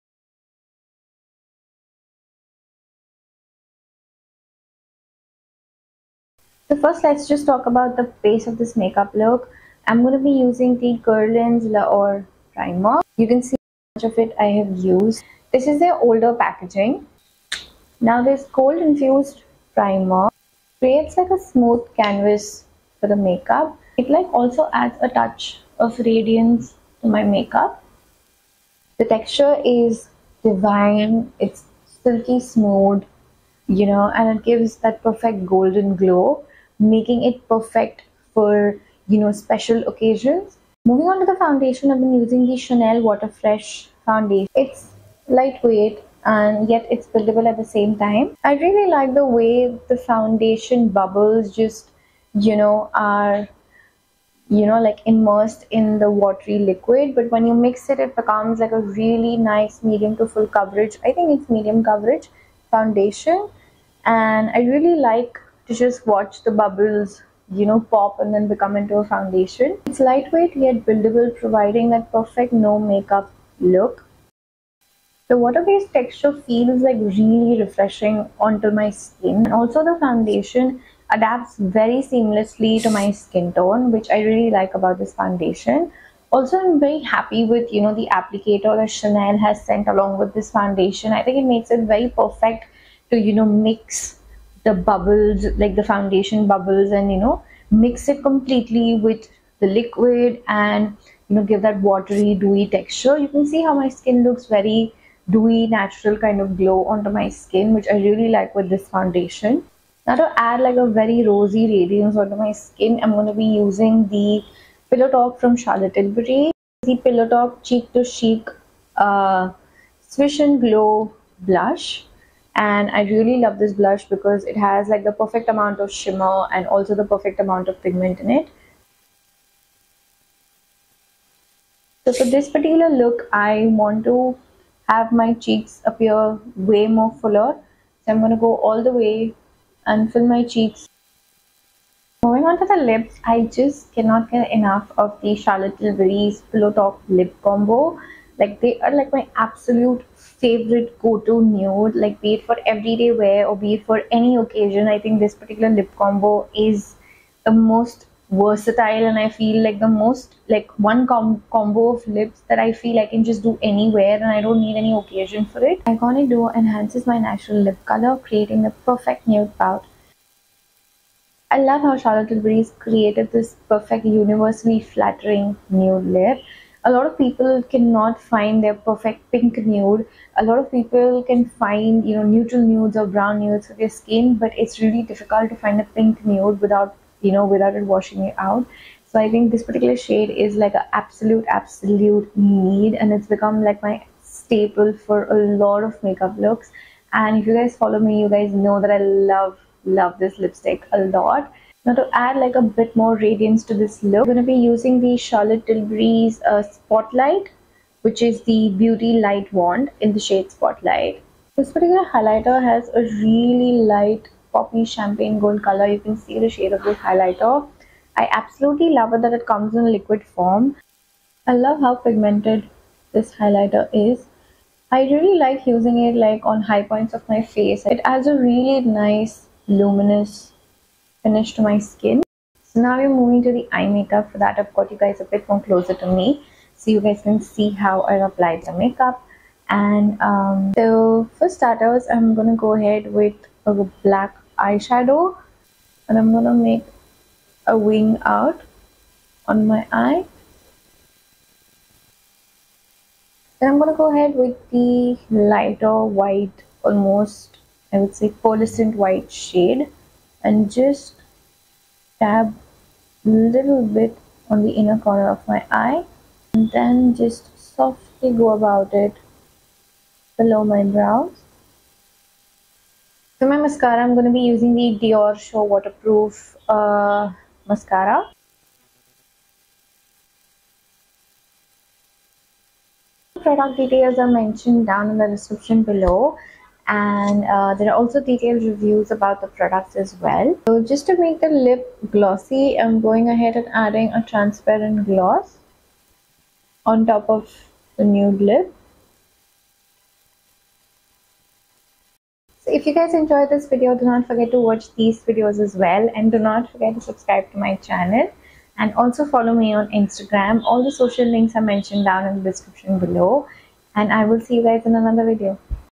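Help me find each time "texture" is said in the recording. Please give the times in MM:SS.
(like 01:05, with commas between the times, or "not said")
00:29, 01:15, 01:42.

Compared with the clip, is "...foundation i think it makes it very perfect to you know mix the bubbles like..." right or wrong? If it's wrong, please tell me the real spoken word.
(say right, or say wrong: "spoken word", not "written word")
right.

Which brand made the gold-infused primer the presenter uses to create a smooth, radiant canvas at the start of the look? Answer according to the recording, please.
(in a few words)
Guerlain.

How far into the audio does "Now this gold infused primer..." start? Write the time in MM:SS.
00:17.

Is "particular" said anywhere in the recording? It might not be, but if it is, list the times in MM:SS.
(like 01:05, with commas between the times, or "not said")
02:12, 02:35, 03:09, 03:31.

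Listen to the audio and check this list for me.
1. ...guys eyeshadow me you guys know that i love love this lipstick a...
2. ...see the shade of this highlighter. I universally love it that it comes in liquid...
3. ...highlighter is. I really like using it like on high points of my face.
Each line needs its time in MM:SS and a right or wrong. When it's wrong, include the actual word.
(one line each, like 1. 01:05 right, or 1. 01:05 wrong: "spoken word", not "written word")
1. 03:17 wrong: "follow", not "eyeshadow"
2. 03:36 wrong: "absolutely", not "universally"
3. 03:43 right.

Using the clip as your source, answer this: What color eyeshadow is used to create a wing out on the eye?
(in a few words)
Black.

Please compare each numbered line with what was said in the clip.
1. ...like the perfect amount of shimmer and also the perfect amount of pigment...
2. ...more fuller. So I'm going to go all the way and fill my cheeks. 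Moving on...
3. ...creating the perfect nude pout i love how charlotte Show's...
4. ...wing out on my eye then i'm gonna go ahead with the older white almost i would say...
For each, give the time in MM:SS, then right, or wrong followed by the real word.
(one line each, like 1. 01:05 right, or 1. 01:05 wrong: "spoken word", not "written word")
1. 02:04 right
2. 02:16 right
3. 02:48 wrong: "Tilbury", not "Show"
4. 04:07 wrong: "lighter", not "older".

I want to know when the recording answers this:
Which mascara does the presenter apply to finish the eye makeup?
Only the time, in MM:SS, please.
04:35.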